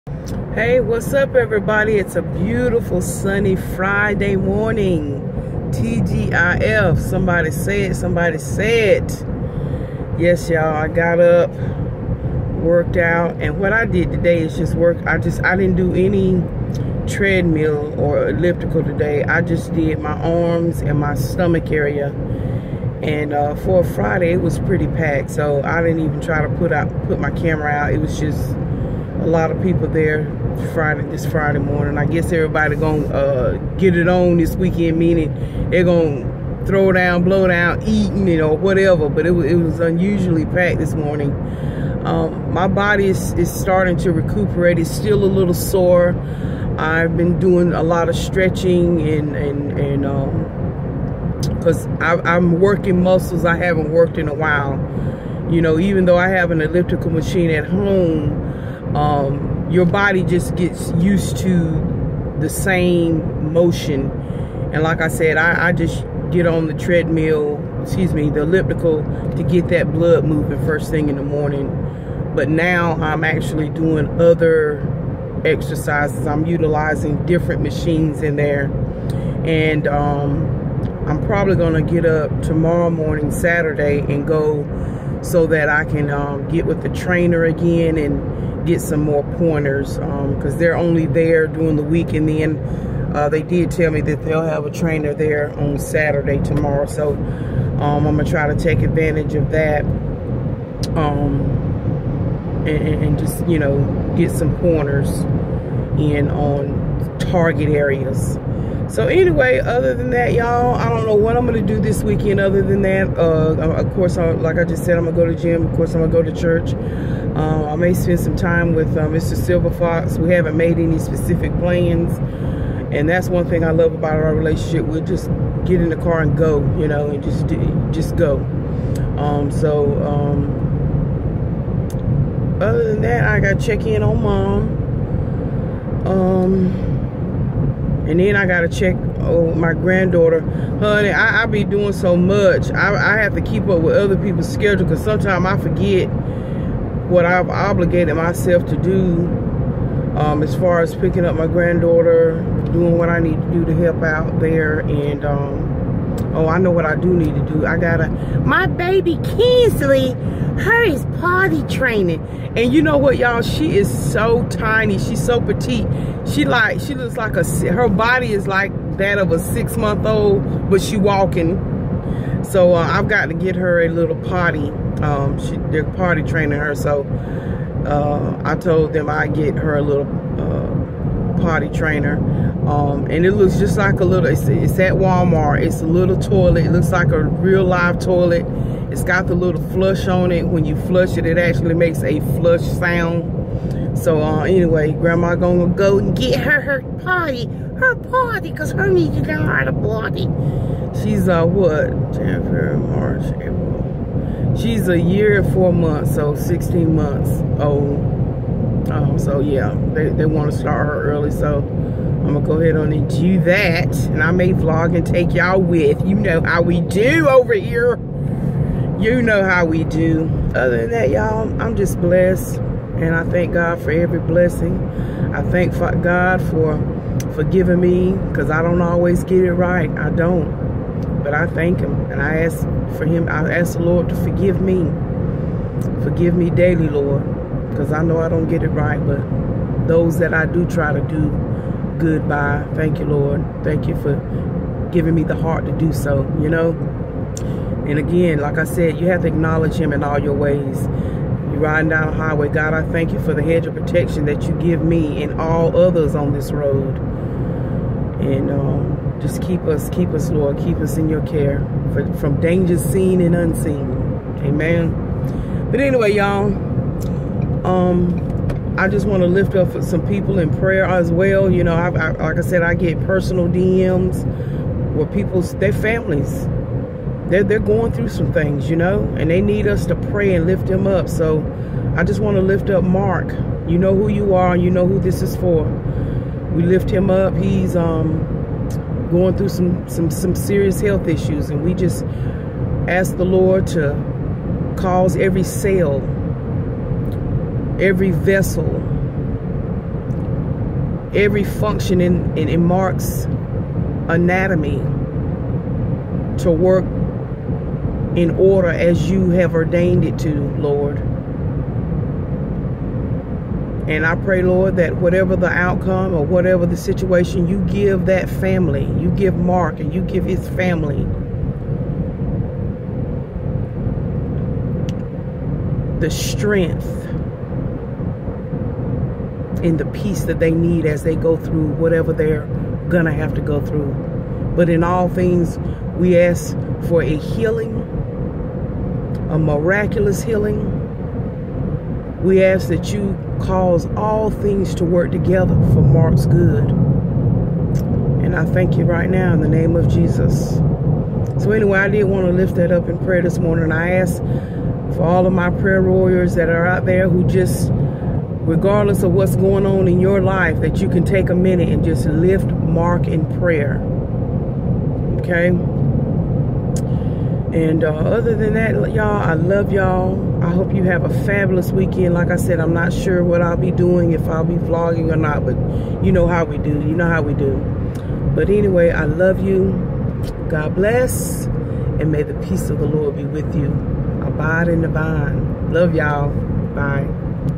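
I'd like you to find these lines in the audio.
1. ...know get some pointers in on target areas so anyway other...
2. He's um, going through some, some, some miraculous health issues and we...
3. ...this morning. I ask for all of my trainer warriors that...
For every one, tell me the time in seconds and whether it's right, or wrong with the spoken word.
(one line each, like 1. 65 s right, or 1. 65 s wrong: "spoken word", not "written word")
1. 103 s right
2. 287 s wrong: "serious", not "miraculous"
3. 353 s wrong: "prayer", not "trainer".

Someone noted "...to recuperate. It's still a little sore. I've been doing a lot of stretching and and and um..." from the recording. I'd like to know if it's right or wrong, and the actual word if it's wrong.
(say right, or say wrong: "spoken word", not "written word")
right.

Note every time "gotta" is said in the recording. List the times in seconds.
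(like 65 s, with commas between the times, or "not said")
133 s, 138 s, 157 s.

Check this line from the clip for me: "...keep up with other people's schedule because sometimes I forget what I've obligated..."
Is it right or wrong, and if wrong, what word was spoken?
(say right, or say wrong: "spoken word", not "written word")
right.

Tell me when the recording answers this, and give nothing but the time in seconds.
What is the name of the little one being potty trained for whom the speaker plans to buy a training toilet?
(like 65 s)
159 s.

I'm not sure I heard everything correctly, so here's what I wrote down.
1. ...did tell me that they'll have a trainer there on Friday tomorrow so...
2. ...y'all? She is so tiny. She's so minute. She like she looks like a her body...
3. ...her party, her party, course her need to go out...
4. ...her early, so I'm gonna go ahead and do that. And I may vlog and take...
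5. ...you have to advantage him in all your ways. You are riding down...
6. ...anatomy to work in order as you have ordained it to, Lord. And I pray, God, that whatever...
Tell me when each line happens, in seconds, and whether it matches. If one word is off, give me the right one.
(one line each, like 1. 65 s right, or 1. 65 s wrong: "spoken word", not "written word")
1. 93 s wrong: "Saturday", not "Friday"
2. 163 s wrong: "petite", not "minute"
3. 196 s wrong: "cause", not "course"
4. 210 s right
5. 248 s wrong: "acknowledge", not "advantage"
6. 304 s wrong: "Lord", not "God".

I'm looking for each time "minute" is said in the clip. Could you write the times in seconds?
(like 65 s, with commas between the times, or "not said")
361 s.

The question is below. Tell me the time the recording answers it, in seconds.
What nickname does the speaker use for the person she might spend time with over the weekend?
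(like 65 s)
119 s.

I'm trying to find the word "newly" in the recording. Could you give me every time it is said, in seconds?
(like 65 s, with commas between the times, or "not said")
not said.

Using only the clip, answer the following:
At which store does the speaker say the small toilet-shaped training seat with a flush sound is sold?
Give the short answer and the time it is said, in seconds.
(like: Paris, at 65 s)
Walmart, at 184 s.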